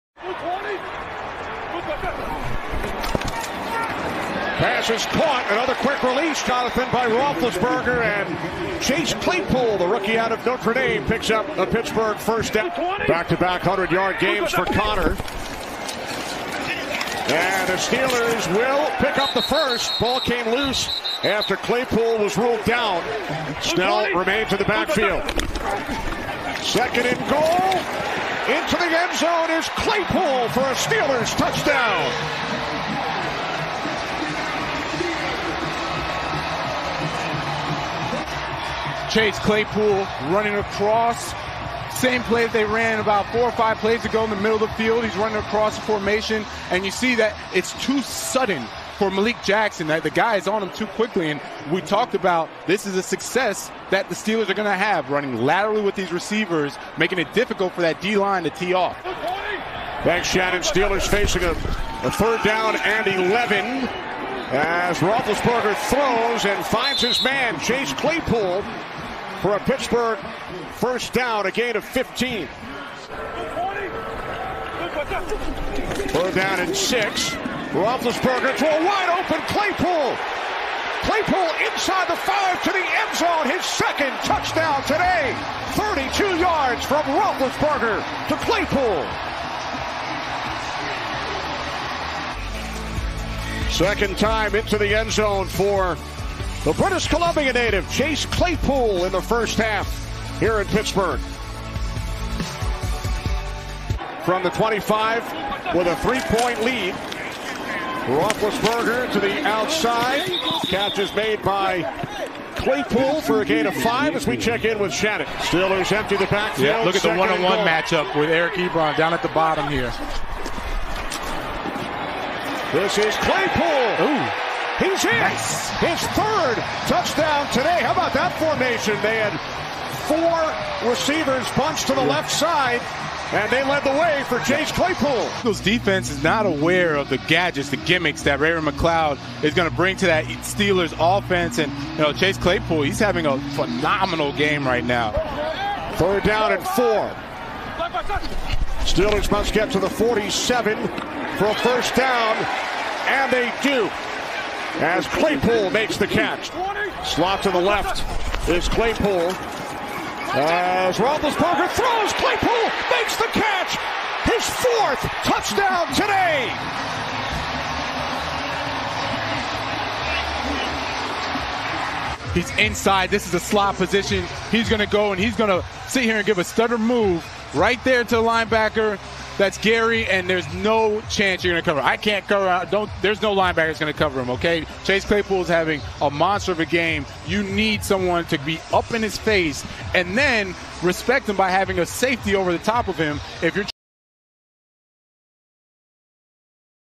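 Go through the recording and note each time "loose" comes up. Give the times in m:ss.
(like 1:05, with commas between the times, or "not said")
0:20.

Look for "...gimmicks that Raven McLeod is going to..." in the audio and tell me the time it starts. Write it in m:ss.
2:17.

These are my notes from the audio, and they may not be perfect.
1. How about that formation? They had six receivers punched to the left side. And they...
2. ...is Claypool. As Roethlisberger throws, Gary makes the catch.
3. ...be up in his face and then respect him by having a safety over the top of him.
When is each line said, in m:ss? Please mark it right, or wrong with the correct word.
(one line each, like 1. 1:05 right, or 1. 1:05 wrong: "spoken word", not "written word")
1. 2:07 wrong: "four", not "six"
2. 2:38 wrong: "Claypool", not "Gary"
3. 3:08 right.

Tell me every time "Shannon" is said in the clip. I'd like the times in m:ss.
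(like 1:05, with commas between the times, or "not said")
1:00, 1:54.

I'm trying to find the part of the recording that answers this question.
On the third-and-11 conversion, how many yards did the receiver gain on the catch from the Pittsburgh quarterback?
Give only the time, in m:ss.
1:11.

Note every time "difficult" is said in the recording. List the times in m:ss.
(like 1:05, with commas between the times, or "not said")
0:57.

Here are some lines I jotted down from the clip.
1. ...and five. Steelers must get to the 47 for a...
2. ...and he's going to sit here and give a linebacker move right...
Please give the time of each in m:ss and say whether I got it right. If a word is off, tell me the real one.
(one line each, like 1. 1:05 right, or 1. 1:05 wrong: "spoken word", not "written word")
1. 2:26 wrong: "four", not "five"
2. 2:55 wrong: "stutter", not "linebacker".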